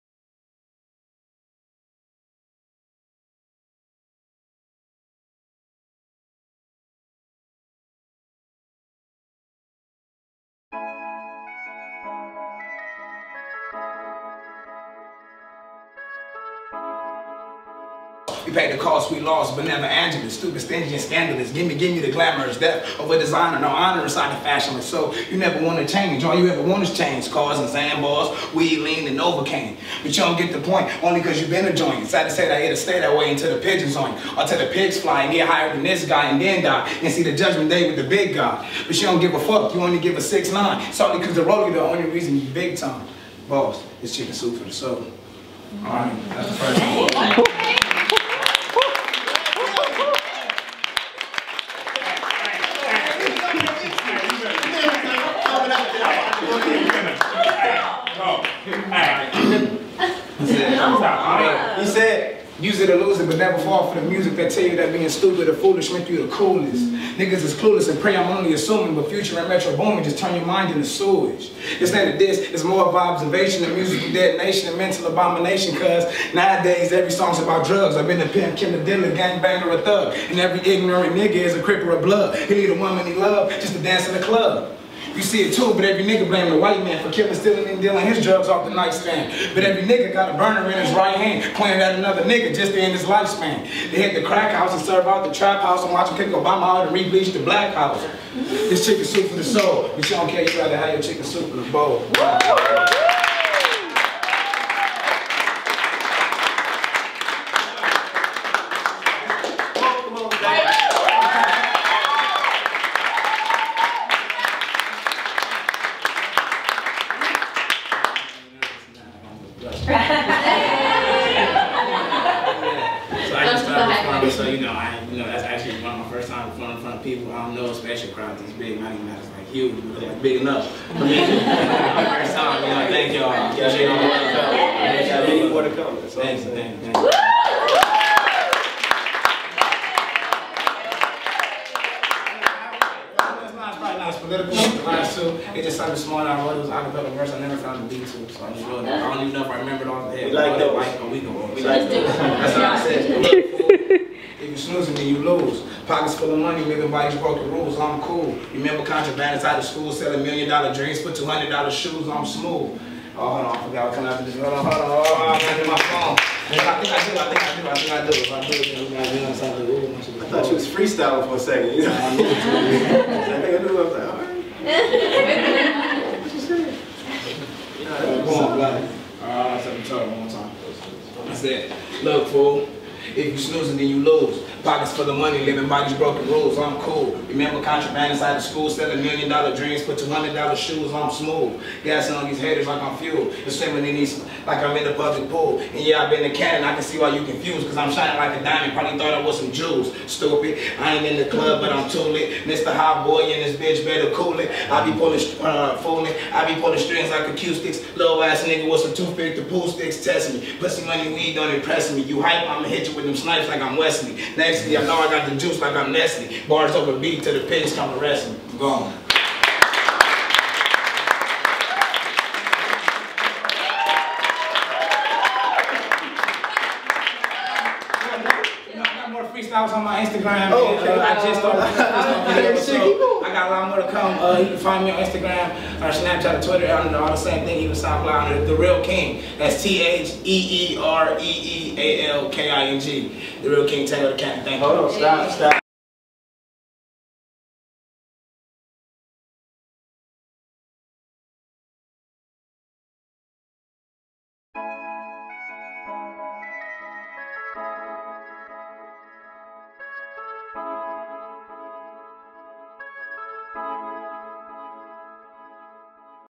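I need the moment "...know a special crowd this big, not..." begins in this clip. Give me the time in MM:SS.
02:07.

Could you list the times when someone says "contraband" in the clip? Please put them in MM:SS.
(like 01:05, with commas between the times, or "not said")
02:38, 03:07.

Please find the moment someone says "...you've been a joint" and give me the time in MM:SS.
00:31.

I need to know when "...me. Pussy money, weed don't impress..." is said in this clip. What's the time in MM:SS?
03:30.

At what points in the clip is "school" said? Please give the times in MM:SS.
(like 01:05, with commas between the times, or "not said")
02:39, 03:08.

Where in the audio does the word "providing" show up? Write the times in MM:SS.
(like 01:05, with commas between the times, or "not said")
not said.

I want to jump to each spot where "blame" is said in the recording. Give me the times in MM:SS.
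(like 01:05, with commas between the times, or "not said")
01:26.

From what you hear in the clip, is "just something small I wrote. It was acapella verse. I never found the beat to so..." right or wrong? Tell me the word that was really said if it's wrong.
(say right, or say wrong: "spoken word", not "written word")
right.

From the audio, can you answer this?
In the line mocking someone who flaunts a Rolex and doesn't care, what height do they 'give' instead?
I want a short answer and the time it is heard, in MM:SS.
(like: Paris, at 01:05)
6'9, at 00:40.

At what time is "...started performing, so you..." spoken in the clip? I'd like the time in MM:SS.
02:03.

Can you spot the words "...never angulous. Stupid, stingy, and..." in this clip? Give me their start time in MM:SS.
00:19.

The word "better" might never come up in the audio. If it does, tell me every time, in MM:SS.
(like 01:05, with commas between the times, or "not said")
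03:23.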